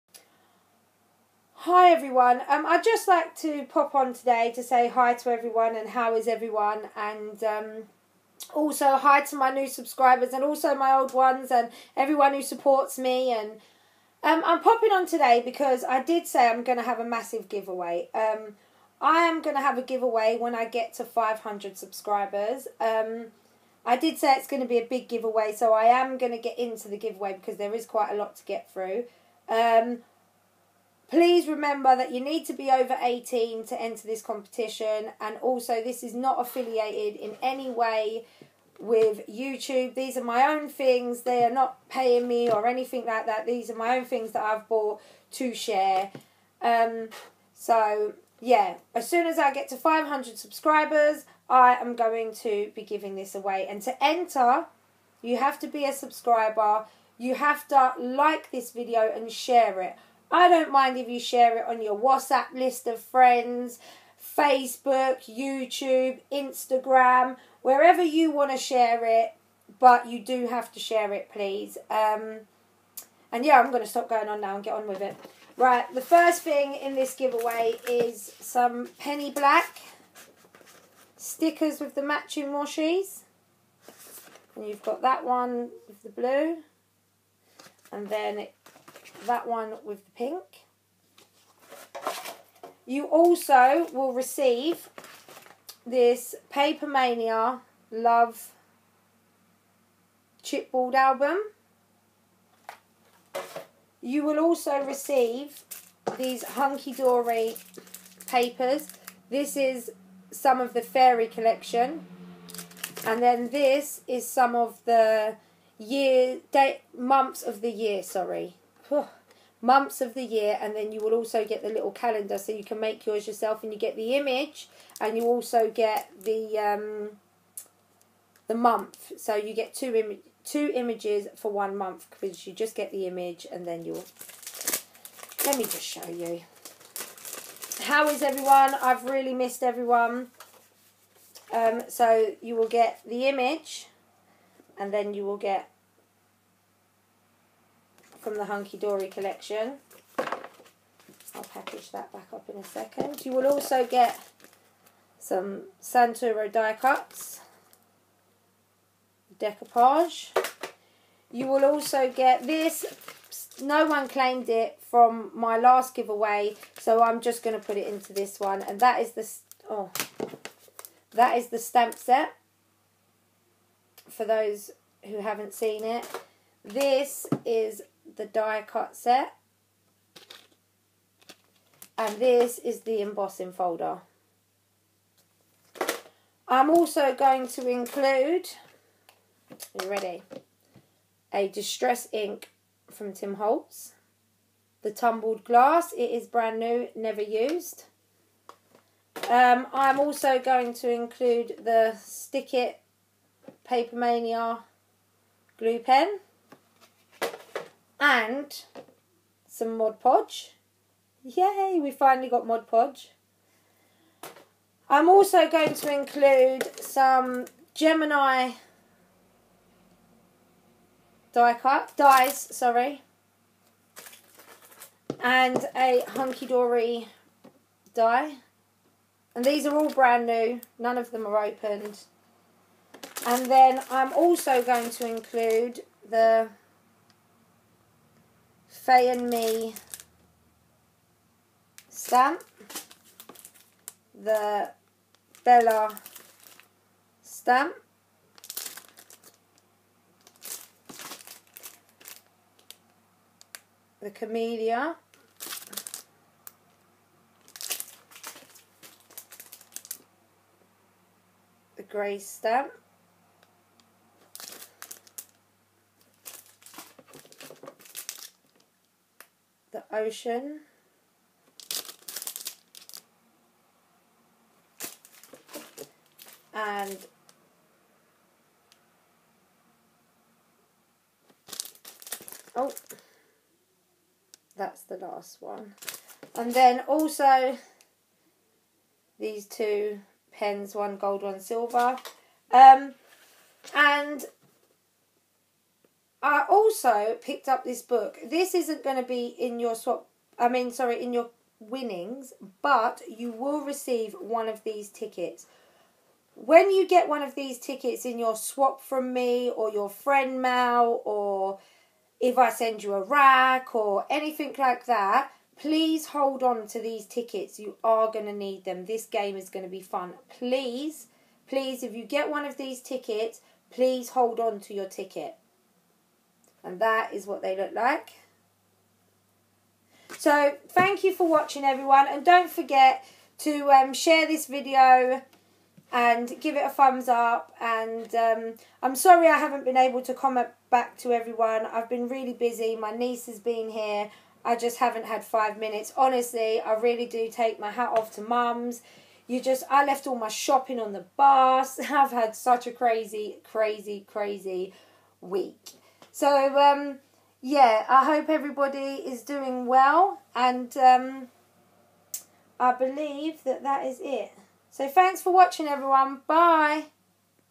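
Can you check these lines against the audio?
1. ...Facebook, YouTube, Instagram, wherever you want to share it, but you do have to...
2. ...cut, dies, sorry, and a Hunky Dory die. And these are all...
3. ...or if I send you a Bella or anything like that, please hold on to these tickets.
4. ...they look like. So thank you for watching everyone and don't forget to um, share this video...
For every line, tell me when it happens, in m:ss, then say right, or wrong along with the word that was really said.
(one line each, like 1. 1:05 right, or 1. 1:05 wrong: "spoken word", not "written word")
1. 1:04 right
2. 3:41 right
3. 5:11 wrong: "RAK", not "Bella"
4. 5:27 right.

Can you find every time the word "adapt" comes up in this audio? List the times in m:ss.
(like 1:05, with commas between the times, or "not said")
not said.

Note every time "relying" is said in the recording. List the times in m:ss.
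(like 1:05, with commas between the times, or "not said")
not said.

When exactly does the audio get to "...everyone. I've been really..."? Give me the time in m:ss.
5:41.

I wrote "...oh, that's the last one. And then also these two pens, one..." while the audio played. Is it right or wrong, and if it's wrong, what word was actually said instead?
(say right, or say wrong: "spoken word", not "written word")
right.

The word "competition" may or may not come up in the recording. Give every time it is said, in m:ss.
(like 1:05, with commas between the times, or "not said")
0:34.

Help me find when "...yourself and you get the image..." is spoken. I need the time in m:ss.
2:03.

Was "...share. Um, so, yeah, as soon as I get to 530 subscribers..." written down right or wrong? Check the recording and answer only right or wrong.
wrong.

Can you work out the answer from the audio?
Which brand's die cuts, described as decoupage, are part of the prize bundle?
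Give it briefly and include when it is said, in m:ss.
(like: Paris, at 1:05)
Santoro, at 2:35.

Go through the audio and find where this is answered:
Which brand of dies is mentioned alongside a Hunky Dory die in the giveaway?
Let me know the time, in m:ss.
3:37.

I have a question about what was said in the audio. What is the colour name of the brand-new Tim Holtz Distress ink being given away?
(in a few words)
Tumbled Glass.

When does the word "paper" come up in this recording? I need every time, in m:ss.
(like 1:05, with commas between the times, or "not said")
1:36, 1:48, 3:23.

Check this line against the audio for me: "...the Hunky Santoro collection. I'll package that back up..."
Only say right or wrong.
wrong.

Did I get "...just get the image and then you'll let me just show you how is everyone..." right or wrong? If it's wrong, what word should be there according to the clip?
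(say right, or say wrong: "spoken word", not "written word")
right.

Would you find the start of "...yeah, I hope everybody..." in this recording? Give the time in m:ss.
5:57.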